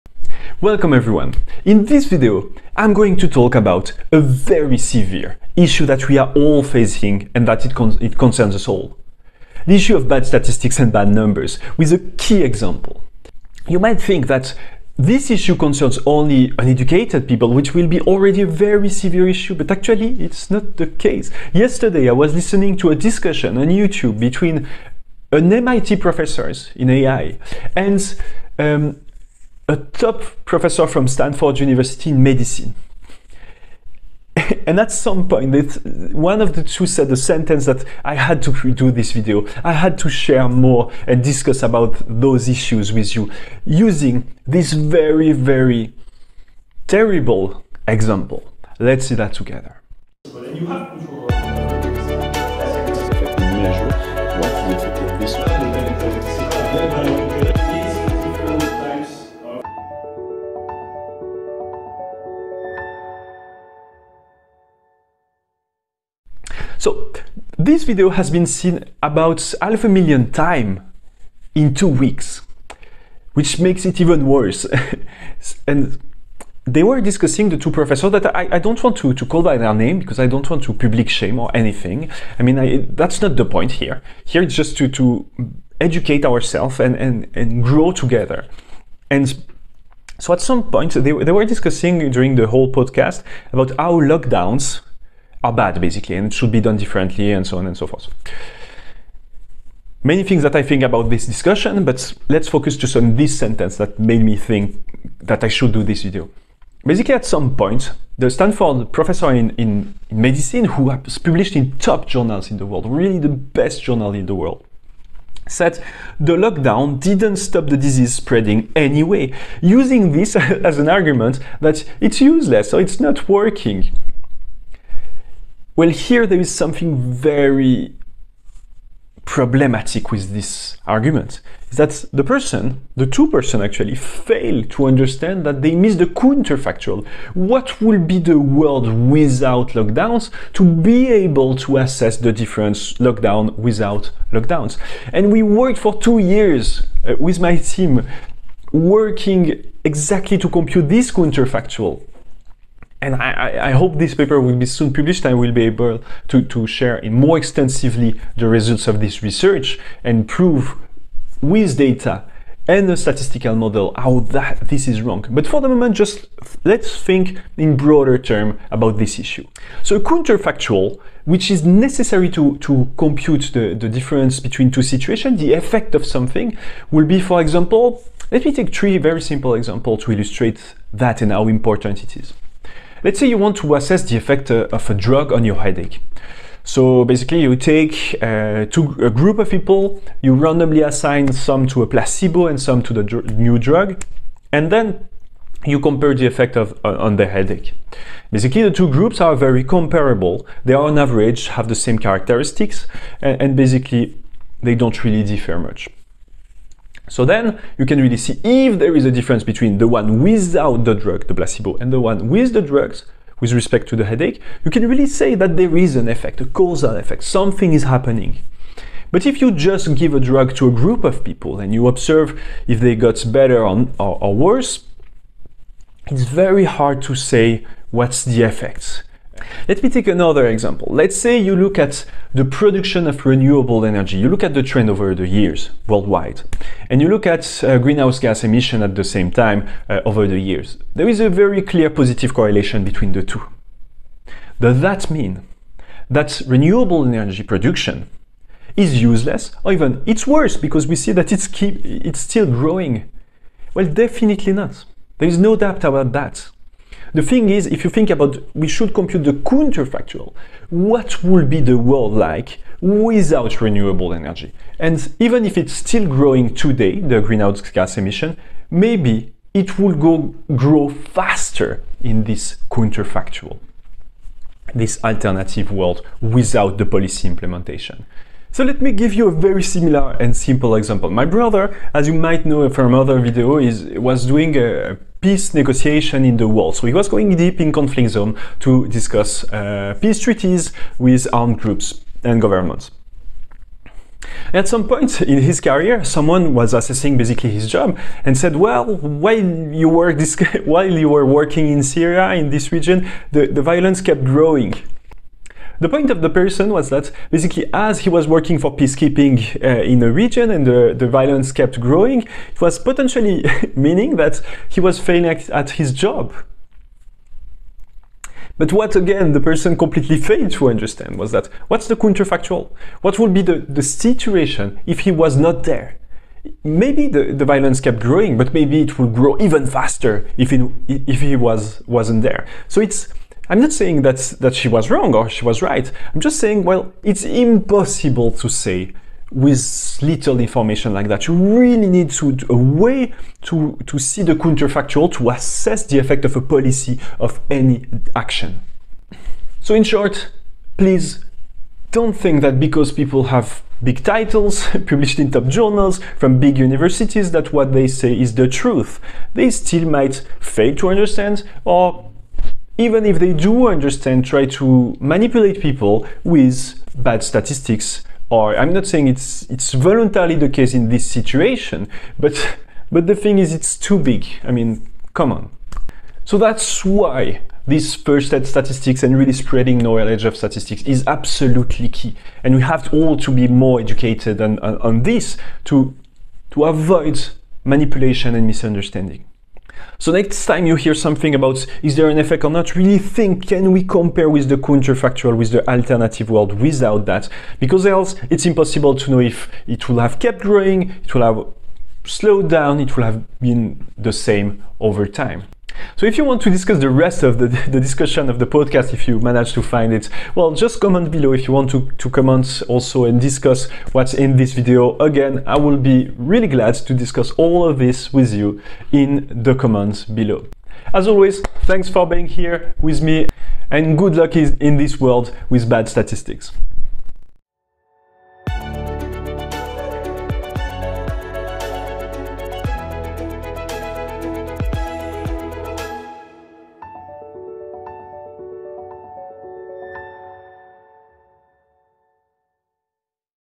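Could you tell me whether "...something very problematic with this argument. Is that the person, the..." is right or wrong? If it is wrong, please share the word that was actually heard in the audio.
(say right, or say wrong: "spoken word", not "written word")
right.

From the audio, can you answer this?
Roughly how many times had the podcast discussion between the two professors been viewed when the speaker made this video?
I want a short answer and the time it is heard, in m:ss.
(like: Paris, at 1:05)
half a million, at 1:09.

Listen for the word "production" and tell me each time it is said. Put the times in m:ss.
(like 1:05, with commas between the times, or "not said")
3:52, 4:07.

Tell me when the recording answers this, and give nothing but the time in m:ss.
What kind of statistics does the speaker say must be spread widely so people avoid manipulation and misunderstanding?
6:17.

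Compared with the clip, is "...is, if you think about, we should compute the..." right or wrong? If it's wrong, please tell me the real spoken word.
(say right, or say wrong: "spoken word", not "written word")
right.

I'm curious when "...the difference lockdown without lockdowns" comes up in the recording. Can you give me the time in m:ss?
2:22.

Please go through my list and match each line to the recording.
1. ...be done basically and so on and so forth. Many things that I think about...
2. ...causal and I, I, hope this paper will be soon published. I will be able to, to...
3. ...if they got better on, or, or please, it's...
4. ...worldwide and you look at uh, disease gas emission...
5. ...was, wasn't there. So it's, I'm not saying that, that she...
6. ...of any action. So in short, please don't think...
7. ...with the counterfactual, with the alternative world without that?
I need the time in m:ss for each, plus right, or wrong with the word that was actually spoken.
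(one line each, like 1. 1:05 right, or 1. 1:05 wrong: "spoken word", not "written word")
1. 1:36 wrong: "differently", not "basically"
2. 2:31 wrong: "counterfactual", not "causal"
3. 3:42 wrong: "worse", not "please"
4. 3:55 wrong: "greenhouse", not "disease"
5. 5:31 right
6. 5:47 right
7. 6:34 right.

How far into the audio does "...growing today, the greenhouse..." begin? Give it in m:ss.
4:26.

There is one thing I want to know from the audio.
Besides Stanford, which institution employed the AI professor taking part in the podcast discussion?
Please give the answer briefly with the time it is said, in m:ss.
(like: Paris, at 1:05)
MIT, at 0:25.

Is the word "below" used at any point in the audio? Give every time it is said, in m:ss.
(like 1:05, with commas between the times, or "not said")
6:51, 7:00.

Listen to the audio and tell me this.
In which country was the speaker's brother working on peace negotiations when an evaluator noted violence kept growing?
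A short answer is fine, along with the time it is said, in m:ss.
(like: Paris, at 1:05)
Syria, at 5:01.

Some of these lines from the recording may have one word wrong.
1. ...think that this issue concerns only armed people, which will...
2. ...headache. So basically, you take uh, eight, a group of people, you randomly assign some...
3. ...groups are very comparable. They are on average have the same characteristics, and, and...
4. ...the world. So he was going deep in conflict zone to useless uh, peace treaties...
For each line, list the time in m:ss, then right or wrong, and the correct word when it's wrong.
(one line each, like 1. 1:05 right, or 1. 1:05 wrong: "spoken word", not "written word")
1. 0:13 wrong: "uneducated", not "armed"
2. 3:05 wrong: "two", not "eight"
3. 3:18 right
4. 4:46 wrong: "discuss", not "useless".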